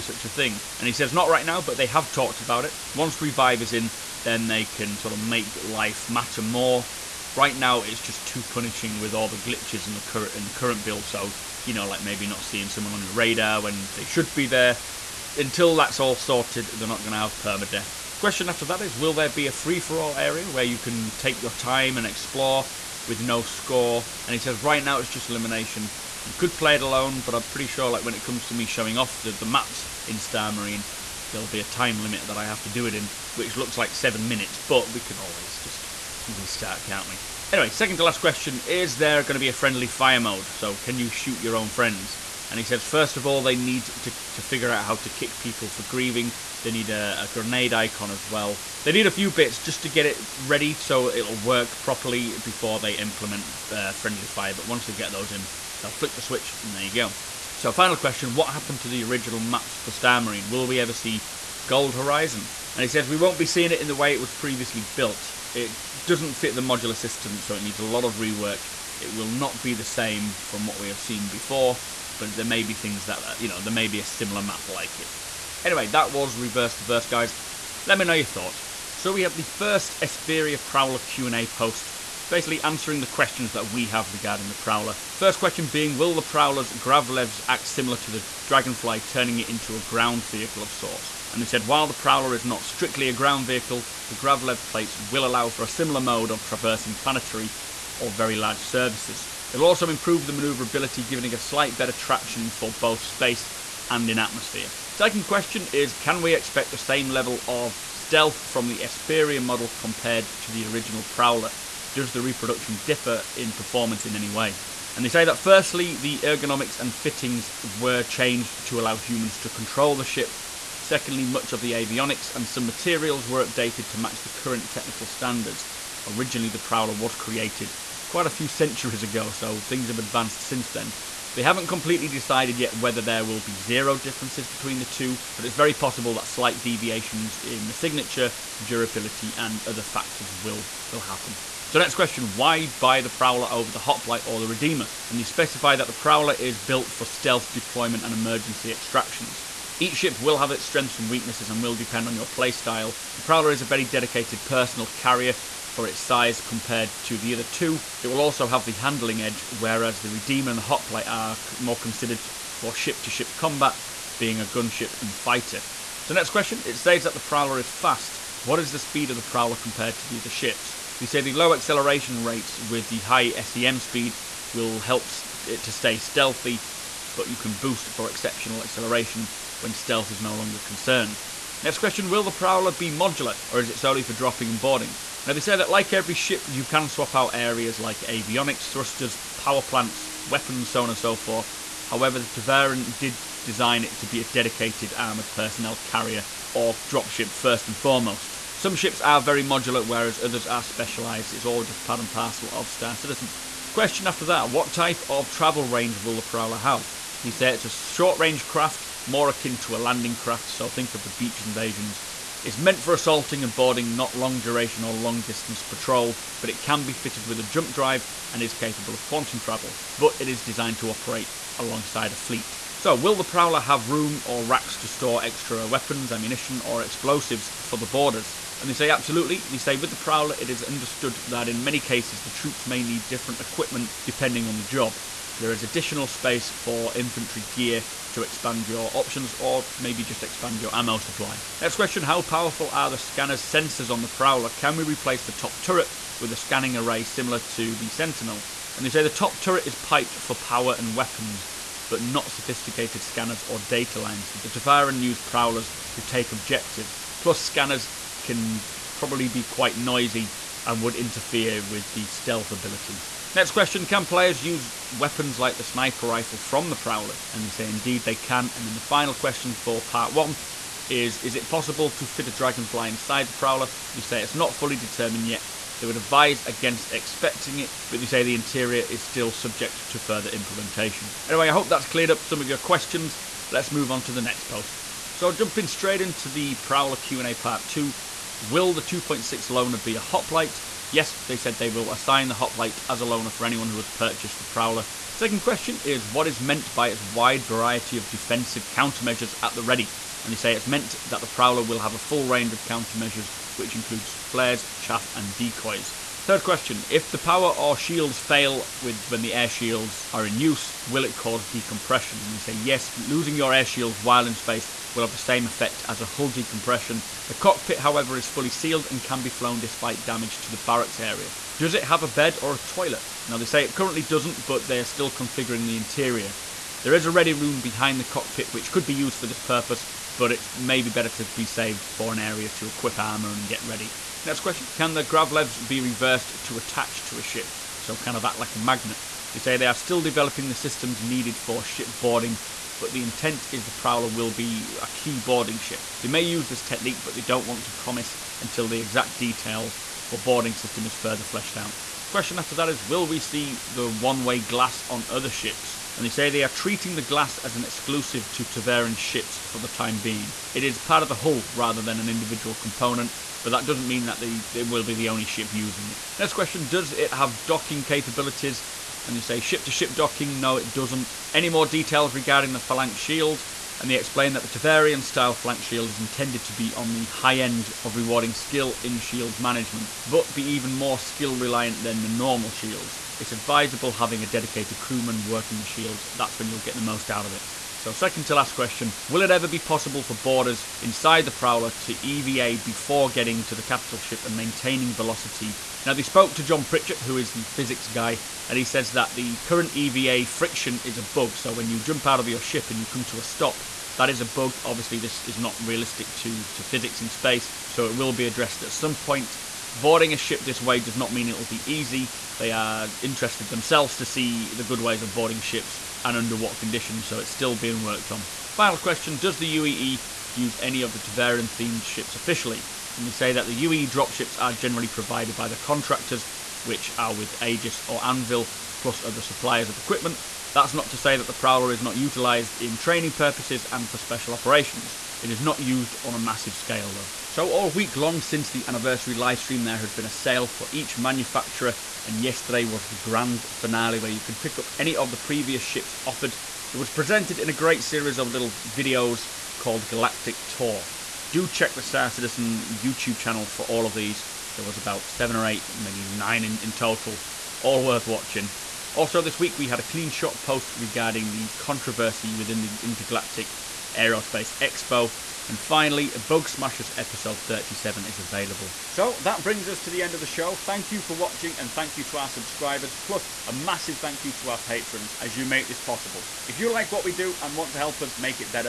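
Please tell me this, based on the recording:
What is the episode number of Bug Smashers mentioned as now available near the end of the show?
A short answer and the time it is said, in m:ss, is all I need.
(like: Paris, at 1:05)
37, at 7:47.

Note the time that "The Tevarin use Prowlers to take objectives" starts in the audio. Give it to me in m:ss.
4:14.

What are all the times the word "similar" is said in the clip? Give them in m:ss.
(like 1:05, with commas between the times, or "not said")
1:14, 1:27, 1:35, 4:07.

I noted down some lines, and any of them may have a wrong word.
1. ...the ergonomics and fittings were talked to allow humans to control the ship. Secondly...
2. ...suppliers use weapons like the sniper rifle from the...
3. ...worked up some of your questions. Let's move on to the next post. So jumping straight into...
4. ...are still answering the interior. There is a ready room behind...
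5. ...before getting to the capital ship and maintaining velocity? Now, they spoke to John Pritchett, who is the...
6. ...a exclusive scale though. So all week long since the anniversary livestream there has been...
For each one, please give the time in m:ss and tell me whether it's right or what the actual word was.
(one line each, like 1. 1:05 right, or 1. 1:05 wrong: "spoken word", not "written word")
1. 1:55 wrong: "changed", not "talked"
2. 4:24 wrong: "players", not "suppliers"
3. 4:41 wrong: "cleared", not "worked"
4. 5:24 wrong: "configuring", not "answering"
5. 6:32 right
6. 7:16 wrong: "massive", not "exclusive".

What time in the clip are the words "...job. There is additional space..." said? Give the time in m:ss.
3:54.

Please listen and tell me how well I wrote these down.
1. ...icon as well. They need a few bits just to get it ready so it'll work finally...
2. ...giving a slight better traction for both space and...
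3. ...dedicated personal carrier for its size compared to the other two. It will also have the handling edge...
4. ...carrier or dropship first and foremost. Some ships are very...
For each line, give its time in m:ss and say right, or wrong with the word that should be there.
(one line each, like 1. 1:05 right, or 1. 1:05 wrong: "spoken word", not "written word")
1. 0:47 wrong: "properly", not "finally"
2. 1:41 right
3. 2:33 right
4. 3:15 right.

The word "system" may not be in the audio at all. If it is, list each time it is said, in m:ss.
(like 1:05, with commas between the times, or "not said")
1:06, 5:40, 5:50.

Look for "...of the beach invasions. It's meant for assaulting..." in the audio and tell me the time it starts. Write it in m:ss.
3:30.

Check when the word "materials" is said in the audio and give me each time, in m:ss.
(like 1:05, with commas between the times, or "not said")
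2:02.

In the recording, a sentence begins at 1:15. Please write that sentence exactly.
Anyway, that was reverse to verse, guys.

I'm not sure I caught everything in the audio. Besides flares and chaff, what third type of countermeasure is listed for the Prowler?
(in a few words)
Decoys.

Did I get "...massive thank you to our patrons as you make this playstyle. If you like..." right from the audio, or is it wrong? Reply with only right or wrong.
wrong.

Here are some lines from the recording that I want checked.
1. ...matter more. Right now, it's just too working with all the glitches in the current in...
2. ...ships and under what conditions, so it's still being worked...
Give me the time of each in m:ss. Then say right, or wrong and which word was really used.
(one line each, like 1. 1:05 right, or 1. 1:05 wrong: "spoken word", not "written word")
1. 0:06 wrong: "punishing", not "working"
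2. 6:55 right.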